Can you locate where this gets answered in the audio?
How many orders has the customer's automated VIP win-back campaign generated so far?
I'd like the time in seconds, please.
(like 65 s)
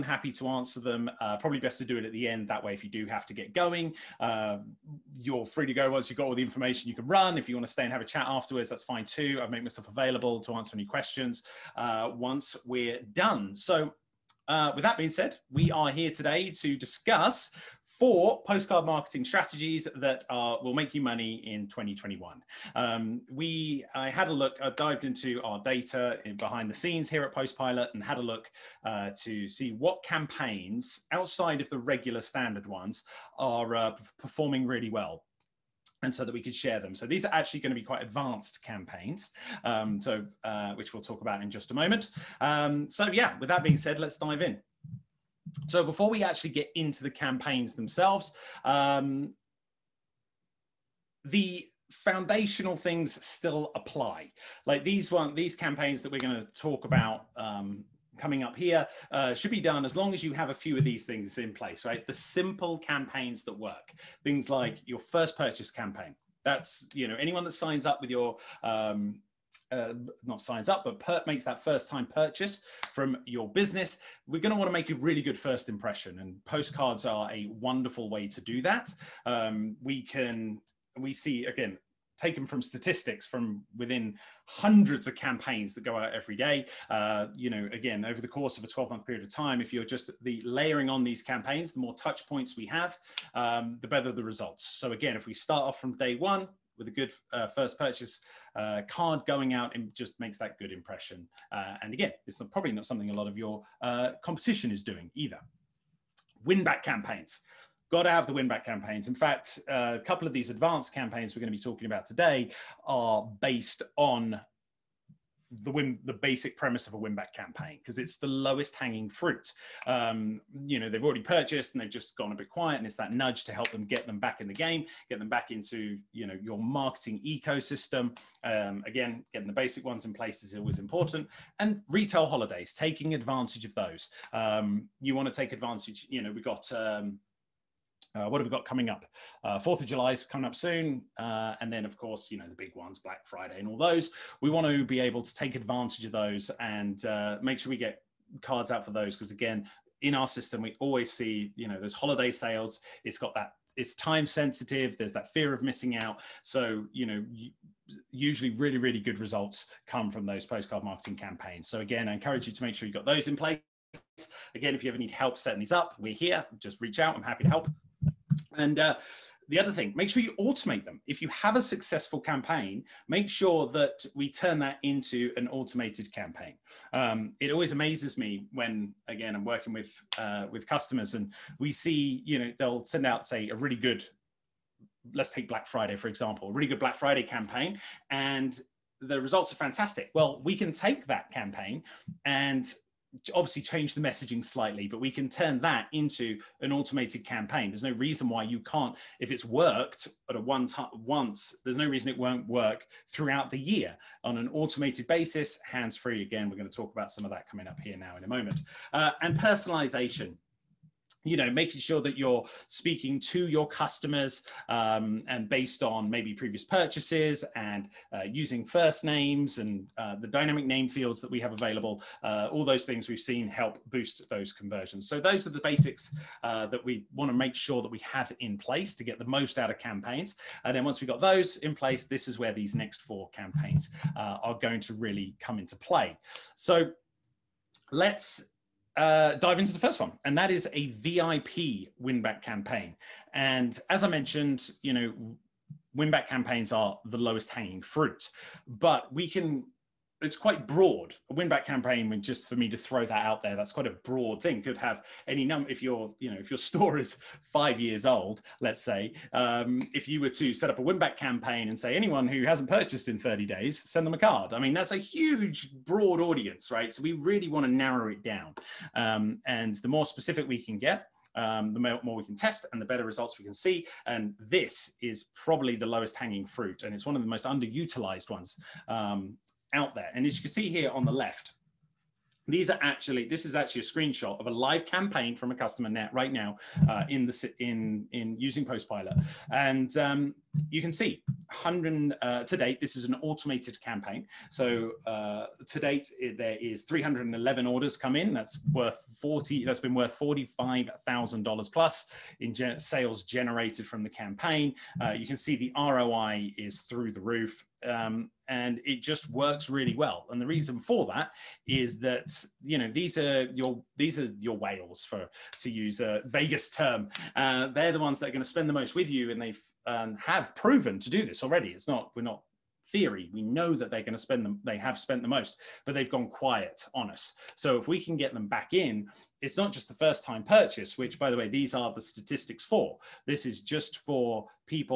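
296 s.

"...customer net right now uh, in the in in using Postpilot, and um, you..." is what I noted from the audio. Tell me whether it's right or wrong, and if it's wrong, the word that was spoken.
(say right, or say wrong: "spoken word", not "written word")
right.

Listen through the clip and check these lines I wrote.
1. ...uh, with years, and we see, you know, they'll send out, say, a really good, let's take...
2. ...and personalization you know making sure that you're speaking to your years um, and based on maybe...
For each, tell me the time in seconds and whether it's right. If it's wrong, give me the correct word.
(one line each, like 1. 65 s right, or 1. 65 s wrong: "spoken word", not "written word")
1. 180 s wrong: "customers", not "years"
2. 209 s wrong: "customers", not "years".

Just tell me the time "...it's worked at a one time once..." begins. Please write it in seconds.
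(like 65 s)
199 s.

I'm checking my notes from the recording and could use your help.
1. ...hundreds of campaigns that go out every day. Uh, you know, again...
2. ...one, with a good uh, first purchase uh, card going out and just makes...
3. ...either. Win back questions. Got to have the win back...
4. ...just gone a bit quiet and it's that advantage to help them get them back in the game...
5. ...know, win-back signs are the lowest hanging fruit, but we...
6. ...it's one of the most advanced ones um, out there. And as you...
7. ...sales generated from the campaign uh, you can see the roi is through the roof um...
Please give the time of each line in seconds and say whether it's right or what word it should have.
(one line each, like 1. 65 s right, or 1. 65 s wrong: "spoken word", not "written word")
1. 84 s right
2. 96 s right
3. 105 s wrong: "campaigns", not "questions"
4. 121 s wrong: "nudge", not "advantage"
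5. 244 s wrong: "campaigns", not "signs"
6. 276 s wrong: "underutilized", not "advanced"
7. 302 s right.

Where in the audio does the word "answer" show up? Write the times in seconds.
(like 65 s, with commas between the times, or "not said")
0 s, 10 s.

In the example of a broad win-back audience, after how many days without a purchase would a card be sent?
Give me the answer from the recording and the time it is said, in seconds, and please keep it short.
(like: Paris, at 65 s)
30 days, at 263 s.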